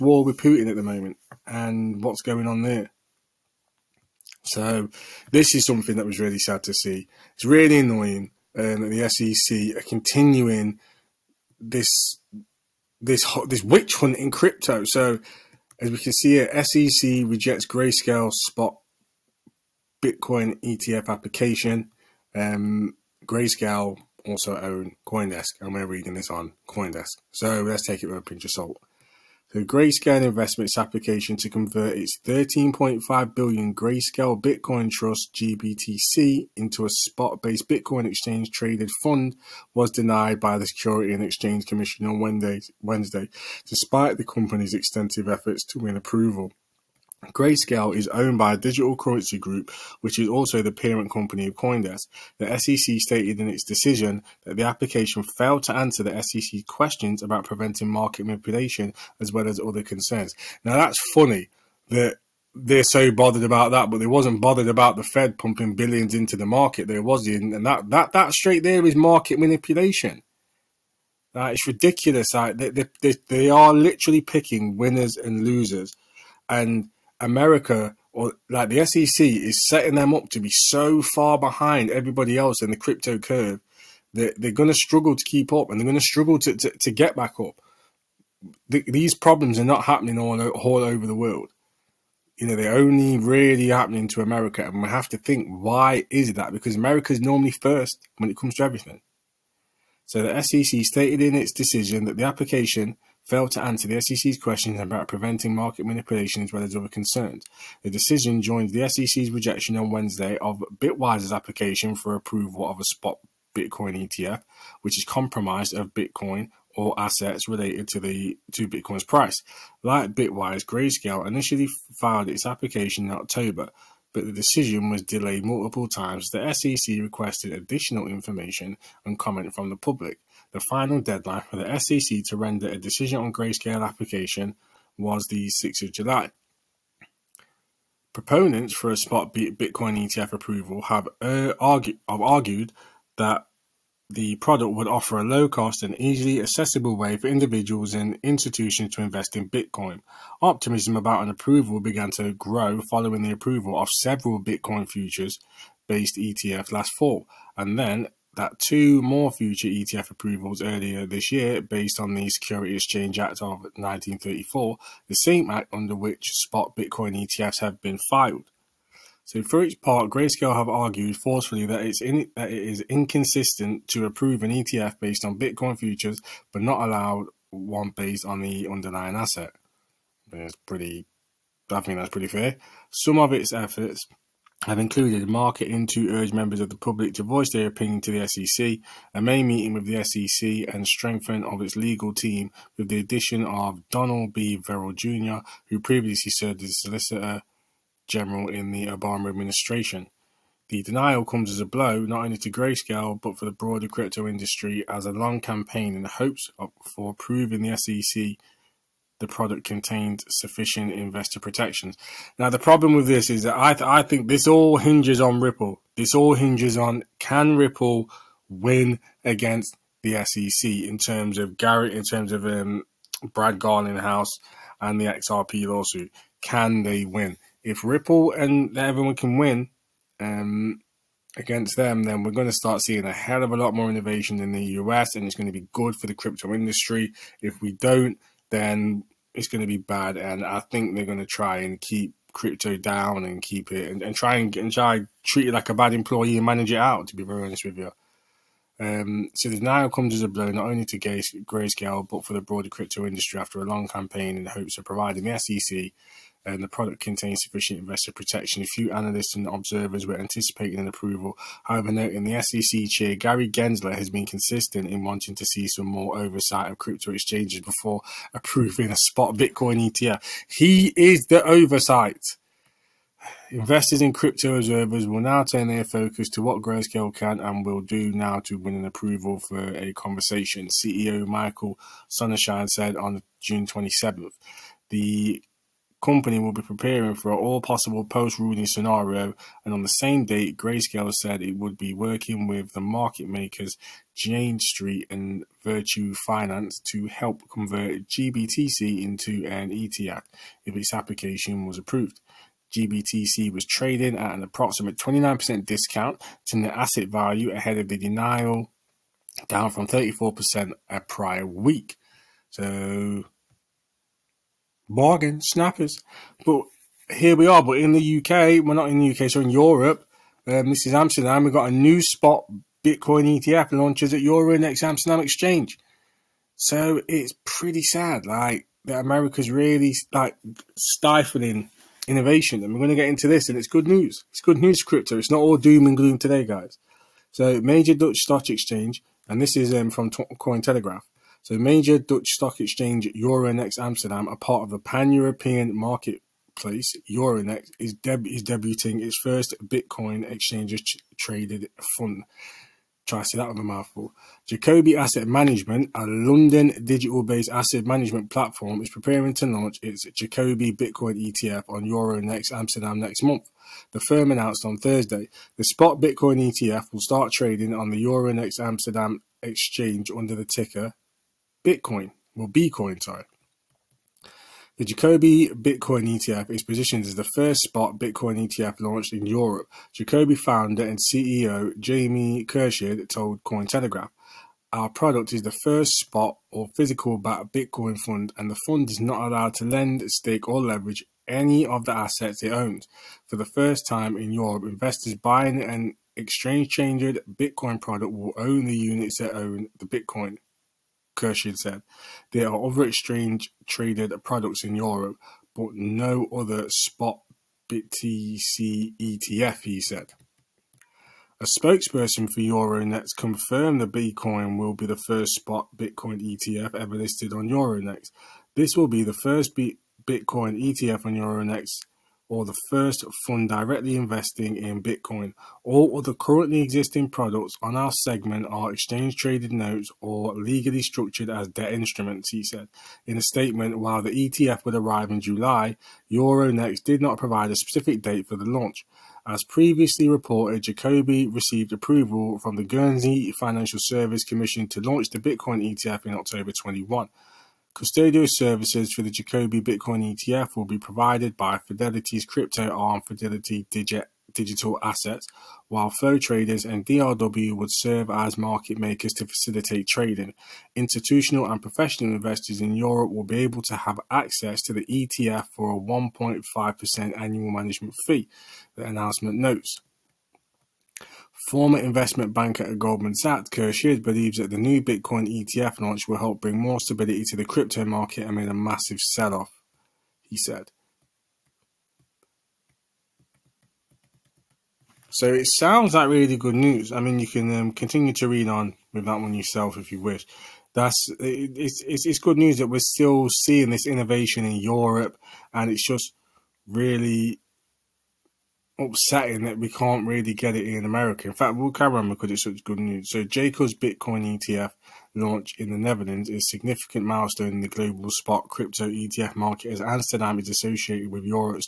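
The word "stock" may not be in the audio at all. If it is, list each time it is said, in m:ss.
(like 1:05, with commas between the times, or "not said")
5:38, 5:42.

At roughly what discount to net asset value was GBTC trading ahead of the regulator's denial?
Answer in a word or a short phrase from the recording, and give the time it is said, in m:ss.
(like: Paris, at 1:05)
29%, at 5:04.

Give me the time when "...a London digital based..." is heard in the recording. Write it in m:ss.
5:55.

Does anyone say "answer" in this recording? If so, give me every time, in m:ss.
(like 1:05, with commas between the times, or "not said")
0:55, 1:43.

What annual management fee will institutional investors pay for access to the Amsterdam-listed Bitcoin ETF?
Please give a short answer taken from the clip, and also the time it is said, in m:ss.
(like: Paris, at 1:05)
1.5%, at 7:45.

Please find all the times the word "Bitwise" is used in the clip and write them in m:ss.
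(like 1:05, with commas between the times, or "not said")
1:50, 2:00.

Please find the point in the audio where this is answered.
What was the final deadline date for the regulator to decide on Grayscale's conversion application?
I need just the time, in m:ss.
2:15.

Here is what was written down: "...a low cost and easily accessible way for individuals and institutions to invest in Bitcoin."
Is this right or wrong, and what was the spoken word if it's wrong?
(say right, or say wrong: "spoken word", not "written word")
right.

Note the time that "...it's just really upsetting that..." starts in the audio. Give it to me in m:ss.
8:15.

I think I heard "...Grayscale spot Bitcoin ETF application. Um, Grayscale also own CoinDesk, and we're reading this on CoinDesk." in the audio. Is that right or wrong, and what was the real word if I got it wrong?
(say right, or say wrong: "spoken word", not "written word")
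right.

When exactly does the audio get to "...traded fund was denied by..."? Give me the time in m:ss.
0:38.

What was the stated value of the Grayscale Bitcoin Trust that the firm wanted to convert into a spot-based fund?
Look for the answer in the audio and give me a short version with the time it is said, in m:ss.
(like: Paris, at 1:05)
13.5 billion, at 0:32.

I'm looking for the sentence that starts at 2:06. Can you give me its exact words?
The SEC requested additional information and comment from the public.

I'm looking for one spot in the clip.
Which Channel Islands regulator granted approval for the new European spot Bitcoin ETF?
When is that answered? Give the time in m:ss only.
7:22.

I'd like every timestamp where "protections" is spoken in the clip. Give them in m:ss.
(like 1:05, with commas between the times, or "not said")
3:31, 4:18.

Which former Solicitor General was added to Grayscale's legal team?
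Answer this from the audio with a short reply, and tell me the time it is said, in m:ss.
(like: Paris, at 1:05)
Donald B. Verrilli Jr., at 3:13.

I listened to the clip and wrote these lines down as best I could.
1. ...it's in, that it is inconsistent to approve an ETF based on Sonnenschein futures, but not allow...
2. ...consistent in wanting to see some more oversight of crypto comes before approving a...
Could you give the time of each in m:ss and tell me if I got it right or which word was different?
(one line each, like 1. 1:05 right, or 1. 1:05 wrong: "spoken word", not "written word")
1. 2:51 wrong: "Bitcoin", not "Sonnenschein"
2. 4:24 wrong: "exchanges", not "comes".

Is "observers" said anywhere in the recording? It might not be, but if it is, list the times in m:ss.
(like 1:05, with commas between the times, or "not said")
4:19, 4:34.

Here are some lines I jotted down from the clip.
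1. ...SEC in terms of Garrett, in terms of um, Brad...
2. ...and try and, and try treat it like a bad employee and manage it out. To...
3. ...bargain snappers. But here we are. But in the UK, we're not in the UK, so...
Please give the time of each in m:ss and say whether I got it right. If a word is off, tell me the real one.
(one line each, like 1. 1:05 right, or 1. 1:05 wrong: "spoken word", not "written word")
1. 3:40 right
2. 4:04 right
3. 5:14 right.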